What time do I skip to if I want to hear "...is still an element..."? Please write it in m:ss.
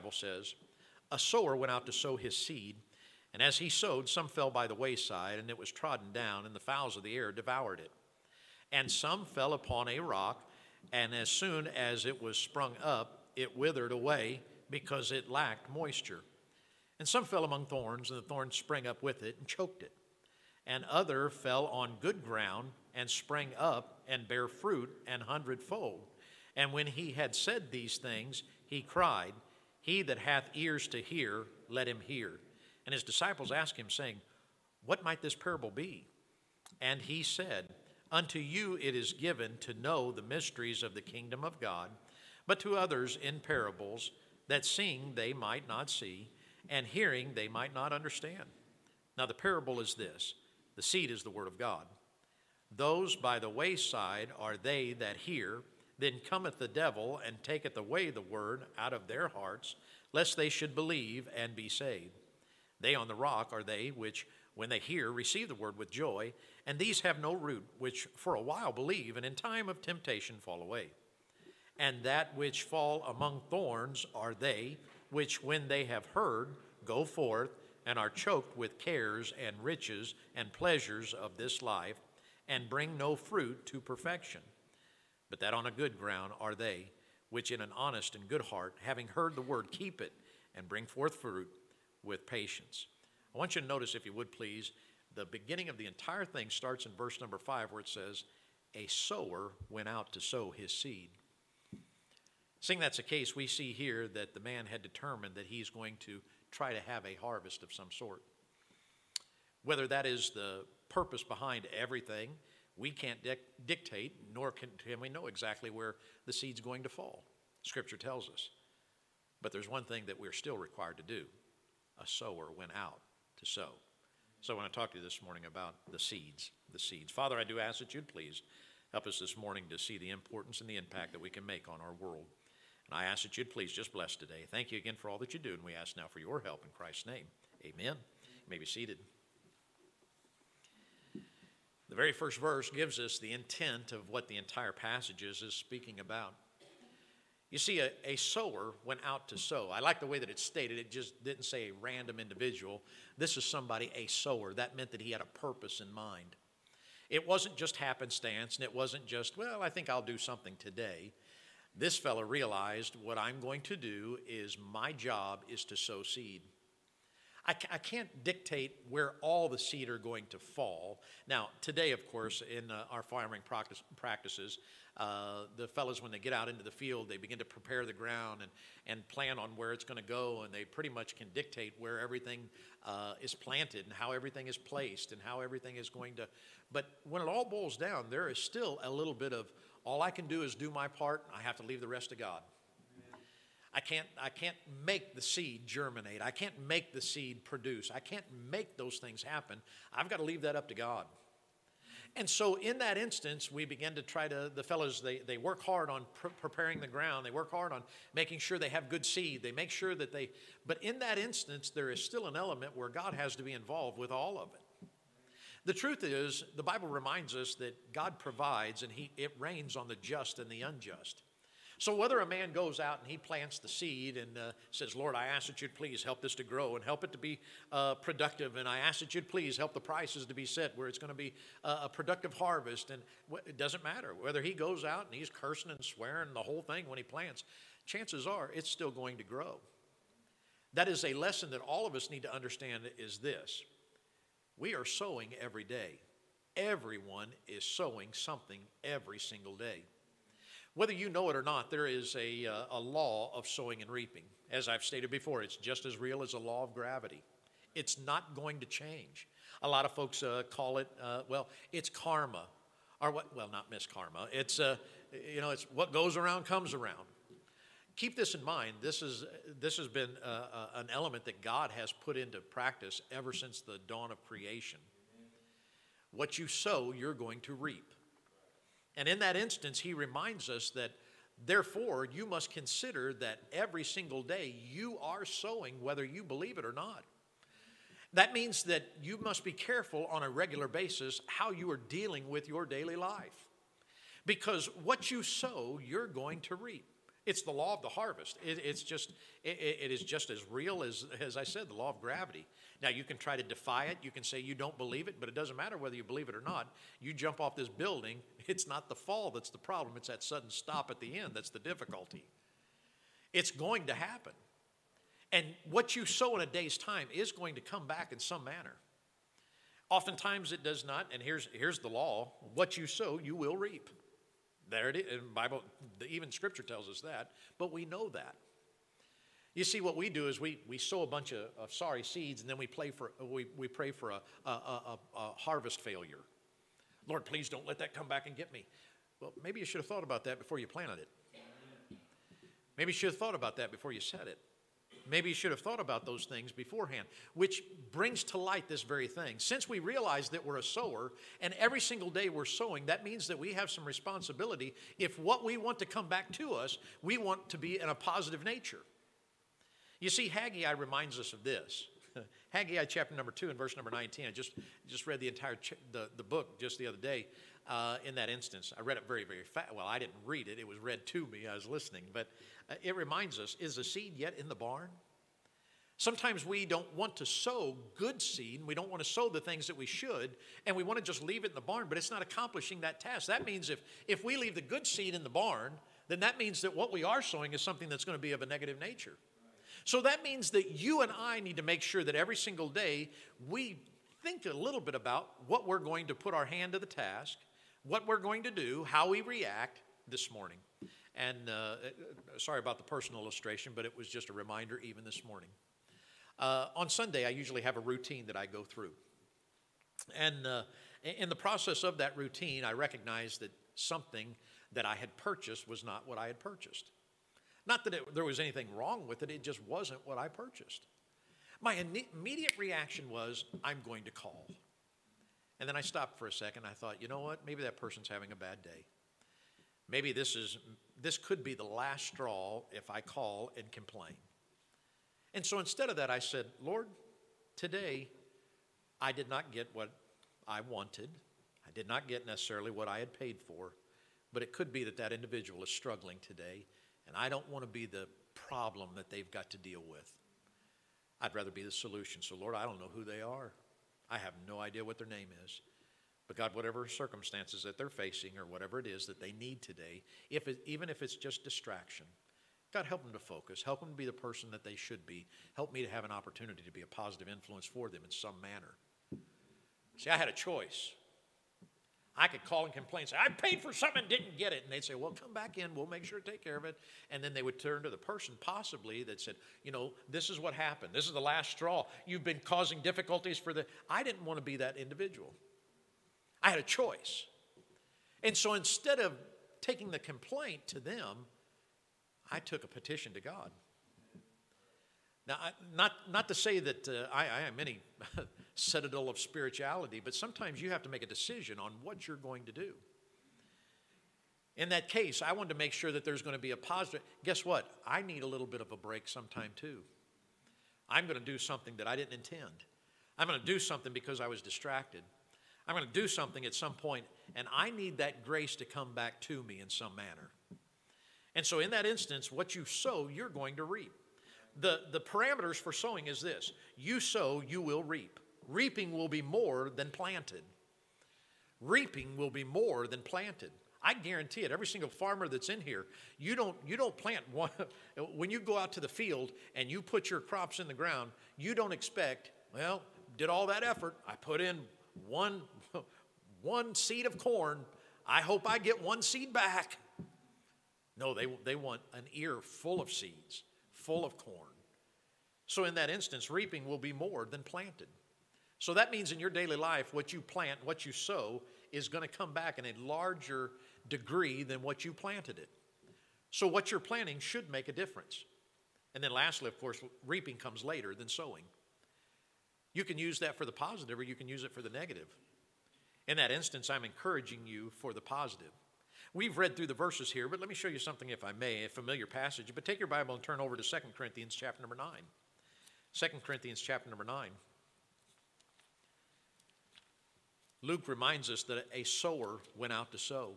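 3:31.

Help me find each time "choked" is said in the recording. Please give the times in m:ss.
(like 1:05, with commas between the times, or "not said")
0:19, 1:18.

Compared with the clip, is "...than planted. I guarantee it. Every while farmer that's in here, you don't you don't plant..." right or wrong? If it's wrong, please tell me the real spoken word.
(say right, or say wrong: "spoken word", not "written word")
wrong: "single", not "while".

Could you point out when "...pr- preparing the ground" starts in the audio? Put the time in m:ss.
3:26.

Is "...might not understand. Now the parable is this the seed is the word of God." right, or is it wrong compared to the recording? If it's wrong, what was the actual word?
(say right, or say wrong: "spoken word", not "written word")
right.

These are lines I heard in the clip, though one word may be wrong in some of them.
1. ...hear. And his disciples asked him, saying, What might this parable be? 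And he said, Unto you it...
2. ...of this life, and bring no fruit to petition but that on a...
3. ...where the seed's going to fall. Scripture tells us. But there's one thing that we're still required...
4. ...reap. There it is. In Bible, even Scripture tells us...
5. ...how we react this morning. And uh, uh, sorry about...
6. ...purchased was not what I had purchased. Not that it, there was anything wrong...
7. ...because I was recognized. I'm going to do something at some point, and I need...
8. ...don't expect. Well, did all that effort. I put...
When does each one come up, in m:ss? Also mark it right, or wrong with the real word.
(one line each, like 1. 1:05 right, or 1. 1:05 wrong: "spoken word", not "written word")
1. 0:31 right
2. 1:21 wrong: "perfection", not "petition"
3. 1:55 right
4. 5:23 right
5. 6:38 right
6. 6:55 right
7. 8:33 wrong: "distracted", not "recognized"
8. 9:01 right.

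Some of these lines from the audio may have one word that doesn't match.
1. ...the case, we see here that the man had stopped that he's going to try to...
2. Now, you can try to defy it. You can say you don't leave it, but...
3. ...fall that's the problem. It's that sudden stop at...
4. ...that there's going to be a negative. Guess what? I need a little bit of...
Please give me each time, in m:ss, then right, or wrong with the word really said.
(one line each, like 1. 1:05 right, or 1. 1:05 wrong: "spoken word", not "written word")
1. 1:42 wrong: "determined", not "stopped"
2. 5:02 wrong: "believe", not "leave"
3. 5:08 right
4. 8:25 wrong: "positive", not "negative".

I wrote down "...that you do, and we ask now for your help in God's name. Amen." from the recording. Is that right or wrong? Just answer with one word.
wrong.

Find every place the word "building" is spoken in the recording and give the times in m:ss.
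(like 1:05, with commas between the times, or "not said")
5:07.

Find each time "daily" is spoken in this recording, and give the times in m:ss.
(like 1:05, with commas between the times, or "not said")
4:52, 9:19.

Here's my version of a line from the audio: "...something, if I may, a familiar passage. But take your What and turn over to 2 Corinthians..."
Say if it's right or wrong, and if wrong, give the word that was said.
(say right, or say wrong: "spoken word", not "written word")
wrong: "Bible", not "What".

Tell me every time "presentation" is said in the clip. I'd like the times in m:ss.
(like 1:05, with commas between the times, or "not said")
not said.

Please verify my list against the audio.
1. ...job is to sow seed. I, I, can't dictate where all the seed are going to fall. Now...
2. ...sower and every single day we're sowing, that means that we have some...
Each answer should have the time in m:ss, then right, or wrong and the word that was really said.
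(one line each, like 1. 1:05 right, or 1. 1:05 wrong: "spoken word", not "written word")
1. 2:44 right
2. 5:50 right.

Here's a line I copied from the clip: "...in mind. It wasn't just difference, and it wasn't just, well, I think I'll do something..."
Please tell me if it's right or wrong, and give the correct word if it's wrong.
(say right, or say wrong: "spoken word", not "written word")
wrong: "happenstance", not "difference".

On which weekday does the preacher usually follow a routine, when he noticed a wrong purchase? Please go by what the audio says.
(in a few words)
Sunday.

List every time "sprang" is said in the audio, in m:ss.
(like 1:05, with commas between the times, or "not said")
0:18, 0:23.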